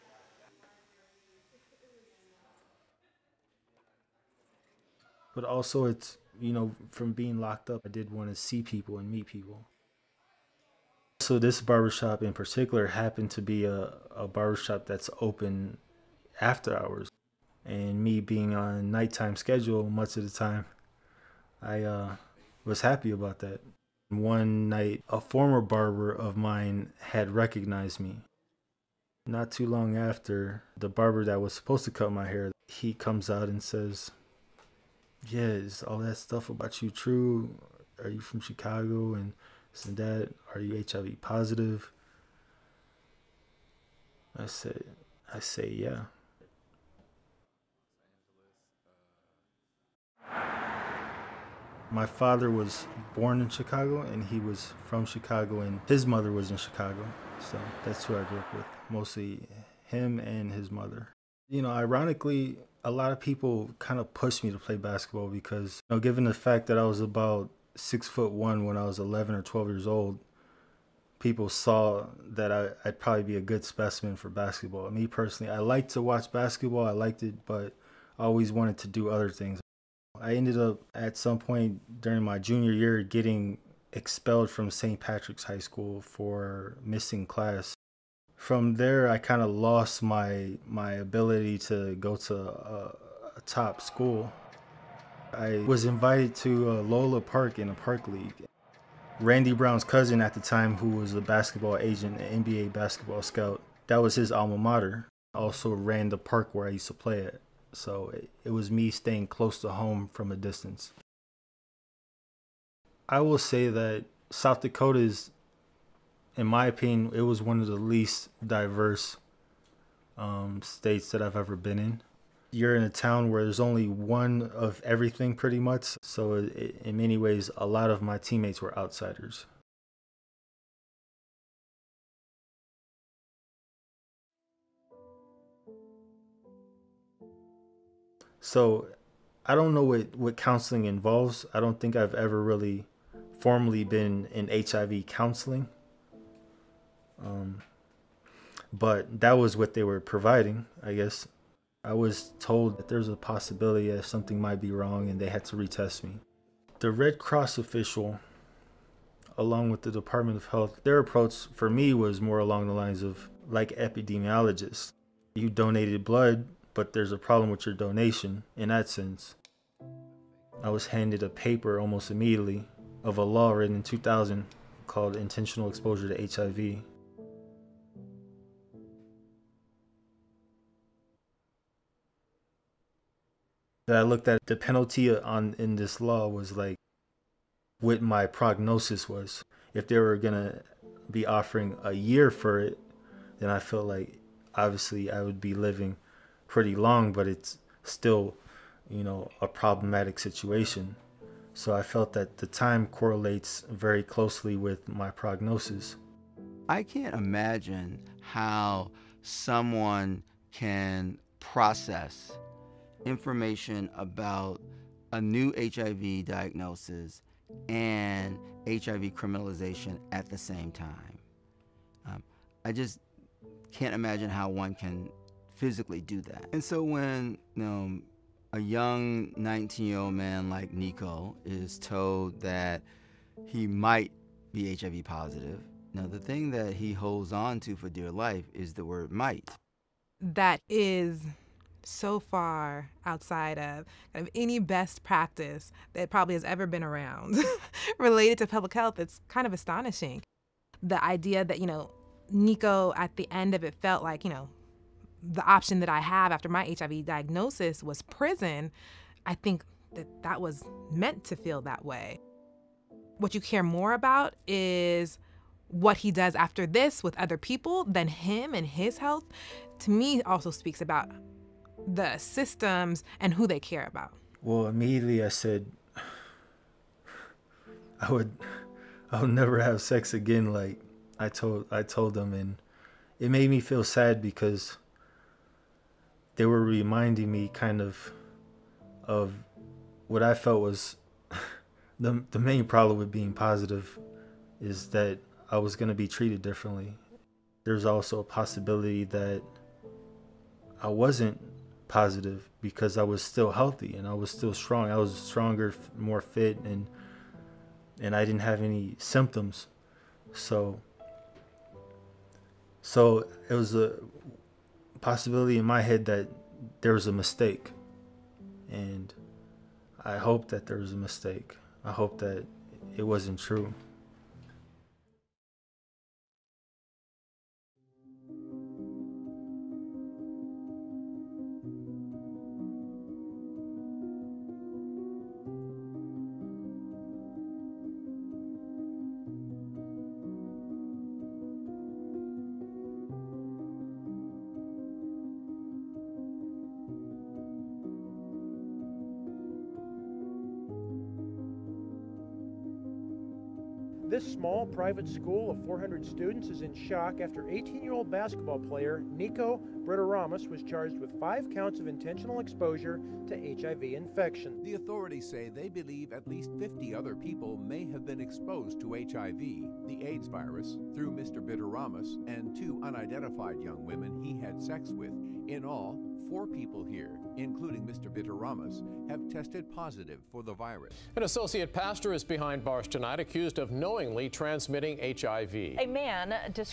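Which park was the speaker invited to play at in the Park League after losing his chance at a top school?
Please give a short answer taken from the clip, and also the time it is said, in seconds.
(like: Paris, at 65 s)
Lola Park, at 96 s.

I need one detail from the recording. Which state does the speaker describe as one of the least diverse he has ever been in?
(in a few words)
South Dakota.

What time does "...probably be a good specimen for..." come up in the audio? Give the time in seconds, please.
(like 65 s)
72 s.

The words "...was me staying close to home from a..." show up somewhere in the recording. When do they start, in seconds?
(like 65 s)
108 s.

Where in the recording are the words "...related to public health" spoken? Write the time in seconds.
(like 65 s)
247 s.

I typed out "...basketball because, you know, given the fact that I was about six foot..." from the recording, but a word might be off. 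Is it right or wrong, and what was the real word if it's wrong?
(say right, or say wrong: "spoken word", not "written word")
right.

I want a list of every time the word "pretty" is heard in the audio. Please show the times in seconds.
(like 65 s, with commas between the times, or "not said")
125 s, 196 s.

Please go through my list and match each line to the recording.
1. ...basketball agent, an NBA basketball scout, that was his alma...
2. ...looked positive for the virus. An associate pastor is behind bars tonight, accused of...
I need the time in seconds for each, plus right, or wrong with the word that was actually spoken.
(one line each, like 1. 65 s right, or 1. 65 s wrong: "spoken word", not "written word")
1. 101 s right
2. 379 s wrong: "tested", not "looked".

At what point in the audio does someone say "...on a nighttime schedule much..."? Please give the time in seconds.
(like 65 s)
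18 s.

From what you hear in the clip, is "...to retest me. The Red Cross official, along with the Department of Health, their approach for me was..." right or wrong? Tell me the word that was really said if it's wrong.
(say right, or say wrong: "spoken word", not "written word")
right.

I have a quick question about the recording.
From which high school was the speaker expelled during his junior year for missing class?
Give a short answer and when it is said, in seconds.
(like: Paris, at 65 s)
St. Patrick's High School, at 84 s.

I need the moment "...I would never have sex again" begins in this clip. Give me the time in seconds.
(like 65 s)
279 s.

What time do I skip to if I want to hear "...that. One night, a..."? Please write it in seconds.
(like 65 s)
23 s.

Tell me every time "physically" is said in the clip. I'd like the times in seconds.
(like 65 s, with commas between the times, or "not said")
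225 s.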